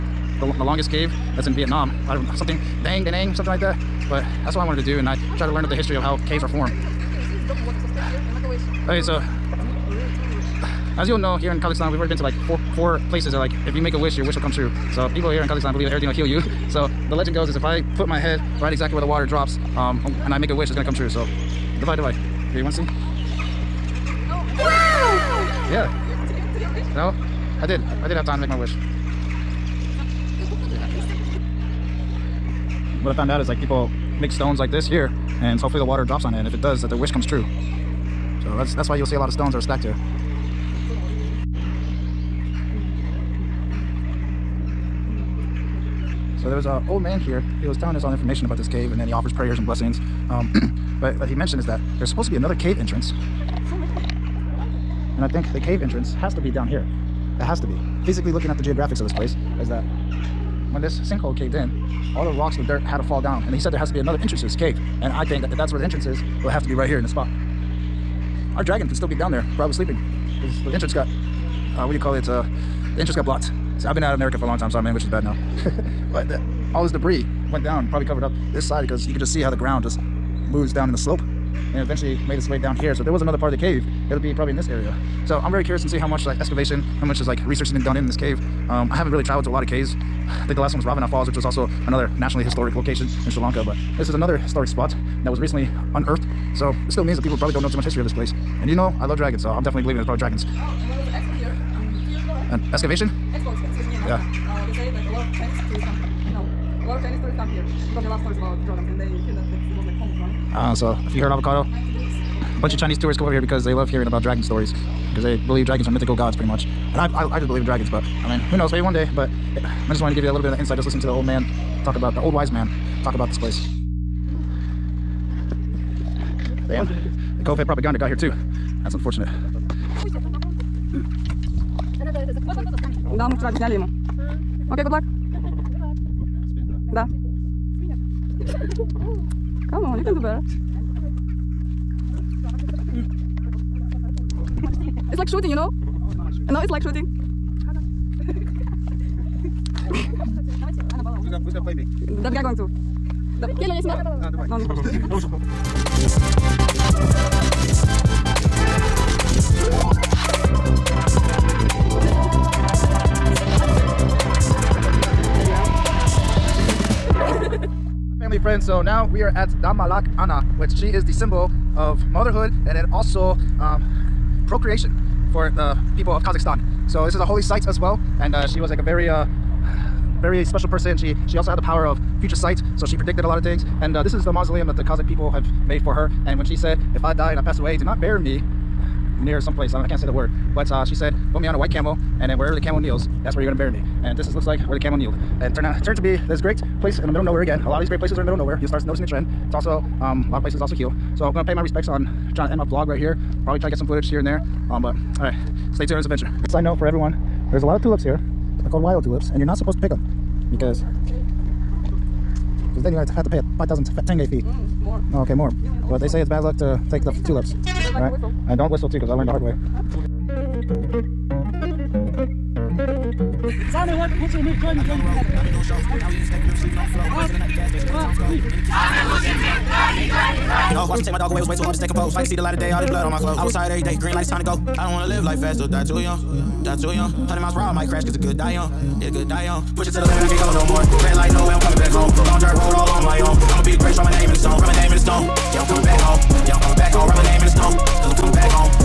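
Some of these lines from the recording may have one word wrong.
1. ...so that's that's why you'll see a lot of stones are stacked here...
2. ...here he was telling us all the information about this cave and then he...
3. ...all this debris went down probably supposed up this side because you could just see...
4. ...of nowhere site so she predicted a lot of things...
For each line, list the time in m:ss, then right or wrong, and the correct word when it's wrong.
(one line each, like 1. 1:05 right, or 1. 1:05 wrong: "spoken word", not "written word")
1. 0:38 right
2. 0:47 right
3. 1:16 wrong: "covered", not "supposed"
4. 3:01 wrong: "future", not "nowhere".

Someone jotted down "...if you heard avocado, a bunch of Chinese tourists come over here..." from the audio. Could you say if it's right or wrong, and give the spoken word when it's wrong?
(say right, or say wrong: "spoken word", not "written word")
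right.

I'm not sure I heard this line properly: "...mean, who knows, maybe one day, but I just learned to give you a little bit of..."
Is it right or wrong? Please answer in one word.
wrong.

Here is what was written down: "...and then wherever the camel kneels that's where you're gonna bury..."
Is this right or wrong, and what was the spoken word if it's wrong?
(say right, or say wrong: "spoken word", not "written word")
right.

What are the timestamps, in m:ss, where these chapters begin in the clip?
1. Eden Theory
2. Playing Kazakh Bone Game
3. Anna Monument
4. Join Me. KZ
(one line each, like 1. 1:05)
1. 0:54
2. 2:10
3. 2:48
4. 3:42.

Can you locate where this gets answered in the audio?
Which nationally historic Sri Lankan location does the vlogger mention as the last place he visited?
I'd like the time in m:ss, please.
1:30.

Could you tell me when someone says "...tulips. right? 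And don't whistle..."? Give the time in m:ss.
3:37.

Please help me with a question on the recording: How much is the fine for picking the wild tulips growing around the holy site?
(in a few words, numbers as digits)
5,000 tenge.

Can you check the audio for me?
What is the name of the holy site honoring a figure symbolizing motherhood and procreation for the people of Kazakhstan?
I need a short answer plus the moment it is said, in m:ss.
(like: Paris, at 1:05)
Damalak Ana, at 2:49.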